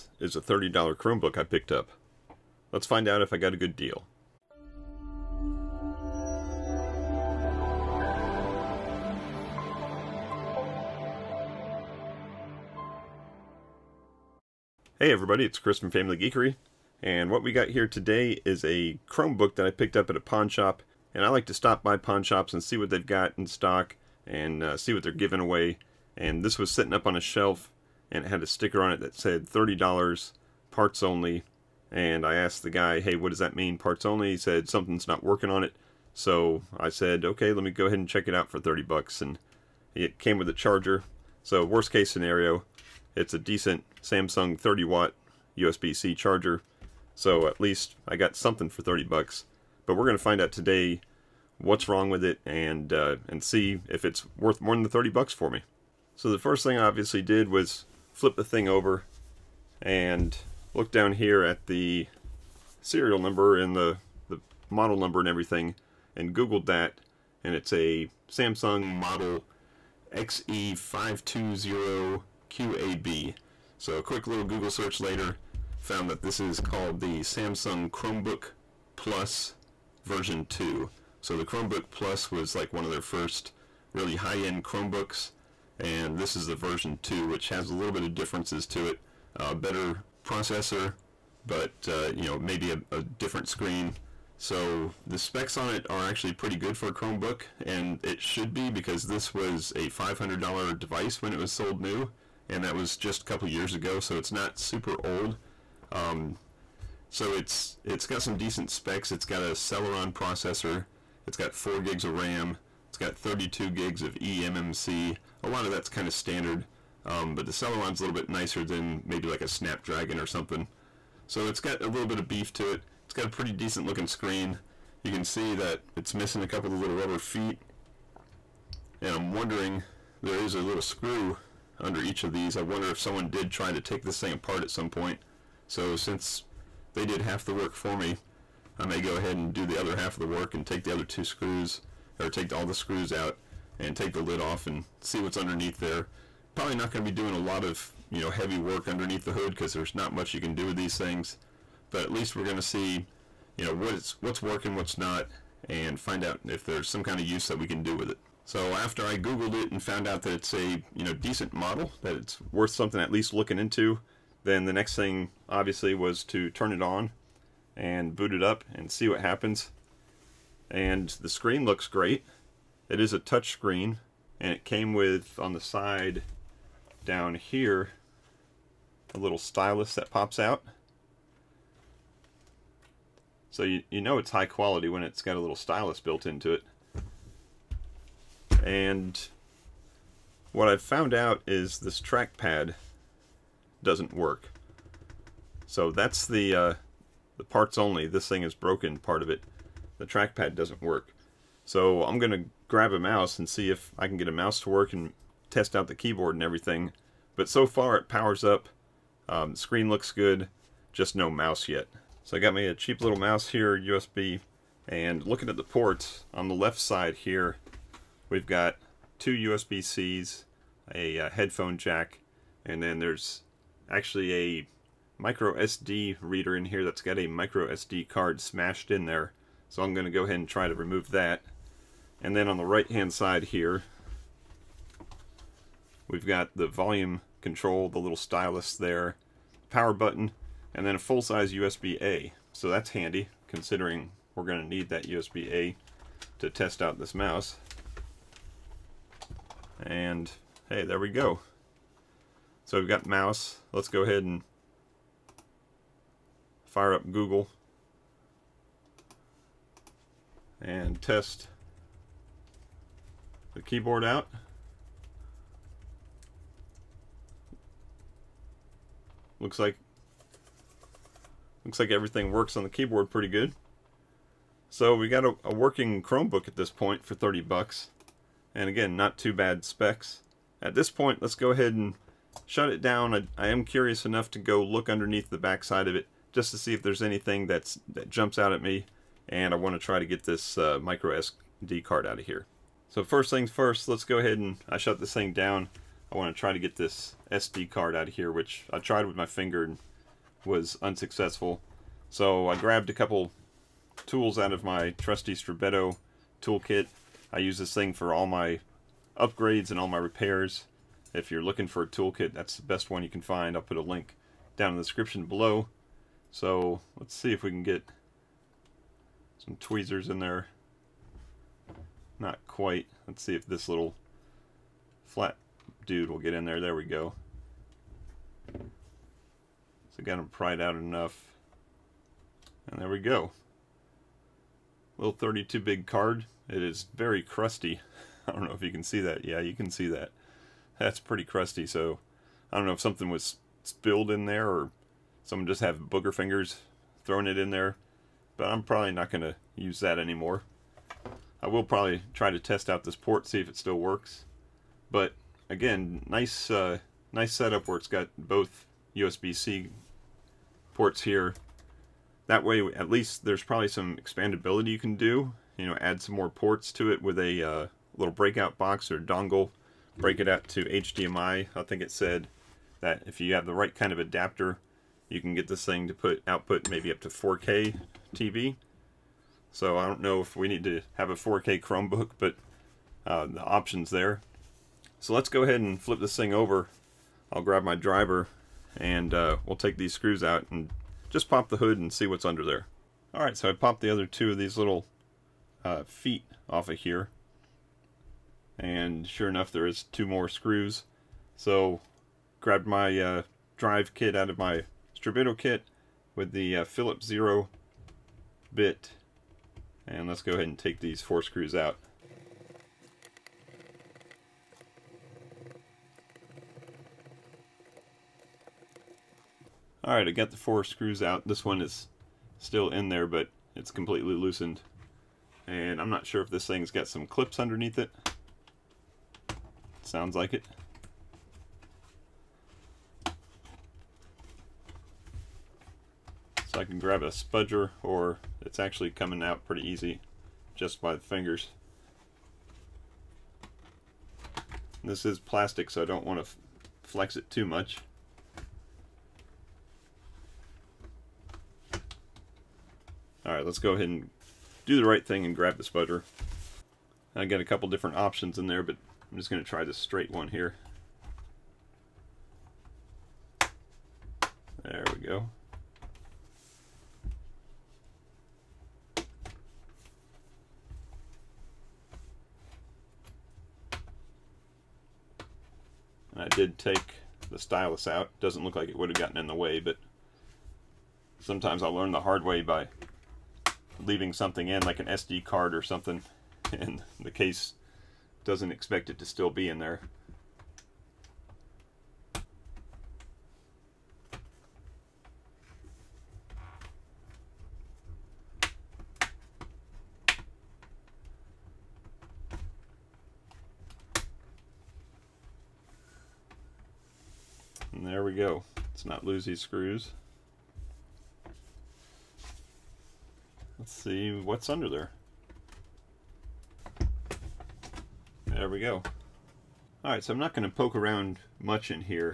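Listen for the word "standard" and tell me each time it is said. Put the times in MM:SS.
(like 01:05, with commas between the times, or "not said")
01:56.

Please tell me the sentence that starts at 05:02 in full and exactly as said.
So I grabbed a couple tools out of my trusty Strebito toolkit.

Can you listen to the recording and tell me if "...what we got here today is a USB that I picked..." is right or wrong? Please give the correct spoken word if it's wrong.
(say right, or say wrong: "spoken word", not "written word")
wrong: "Chromebook", not "USB".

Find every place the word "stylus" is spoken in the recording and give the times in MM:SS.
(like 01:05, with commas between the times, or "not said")
02:59, 03:05, 03:58, 07:57.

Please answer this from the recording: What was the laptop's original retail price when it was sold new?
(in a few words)
$500.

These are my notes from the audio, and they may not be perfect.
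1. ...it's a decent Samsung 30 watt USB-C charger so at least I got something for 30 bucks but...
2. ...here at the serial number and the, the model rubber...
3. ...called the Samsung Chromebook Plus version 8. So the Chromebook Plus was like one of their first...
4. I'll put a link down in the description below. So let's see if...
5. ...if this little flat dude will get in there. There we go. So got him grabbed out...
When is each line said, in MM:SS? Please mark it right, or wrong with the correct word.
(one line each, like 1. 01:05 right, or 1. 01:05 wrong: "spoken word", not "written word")
1. 00:43 right
2. 01:01 wrong: "number", not "rubber"
3. 01:16 wrong: "2", not "8"
4. 05:13 right
5. 05:23 wrong: "pried", not "grabbed".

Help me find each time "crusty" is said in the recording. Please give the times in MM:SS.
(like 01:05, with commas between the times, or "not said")
05:37, 05:41.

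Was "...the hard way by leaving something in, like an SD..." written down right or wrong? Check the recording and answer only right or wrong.
right.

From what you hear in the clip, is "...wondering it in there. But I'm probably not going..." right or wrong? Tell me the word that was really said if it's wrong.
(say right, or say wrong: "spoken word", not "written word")
wrong: "throwing", not "wondering".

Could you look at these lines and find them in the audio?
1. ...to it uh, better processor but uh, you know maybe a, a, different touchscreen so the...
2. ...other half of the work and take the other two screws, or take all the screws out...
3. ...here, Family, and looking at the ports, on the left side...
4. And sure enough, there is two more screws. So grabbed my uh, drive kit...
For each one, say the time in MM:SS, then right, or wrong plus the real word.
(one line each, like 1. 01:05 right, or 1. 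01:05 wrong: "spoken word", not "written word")
1. 01:28 wrong: "screen", not "touchscreen"
2. 02:19 right
3. 03:33 wrong: "USB", not "Family"
4. 06:38 right.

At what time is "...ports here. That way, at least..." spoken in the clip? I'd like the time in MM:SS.
06:00.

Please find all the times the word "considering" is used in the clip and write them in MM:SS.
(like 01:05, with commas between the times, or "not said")
04:03.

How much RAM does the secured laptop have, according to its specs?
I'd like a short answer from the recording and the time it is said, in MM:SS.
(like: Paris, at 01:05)
4 GB, at 01:51.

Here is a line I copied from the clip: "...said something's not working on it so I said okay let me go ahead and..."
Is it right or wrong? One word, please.
right.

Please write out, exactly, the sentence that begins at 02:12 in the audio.
I wonder if someone did try to take this thing apart at some point.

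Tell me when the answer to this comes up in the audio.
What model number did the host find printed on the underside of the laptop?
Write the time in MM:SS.
01:10.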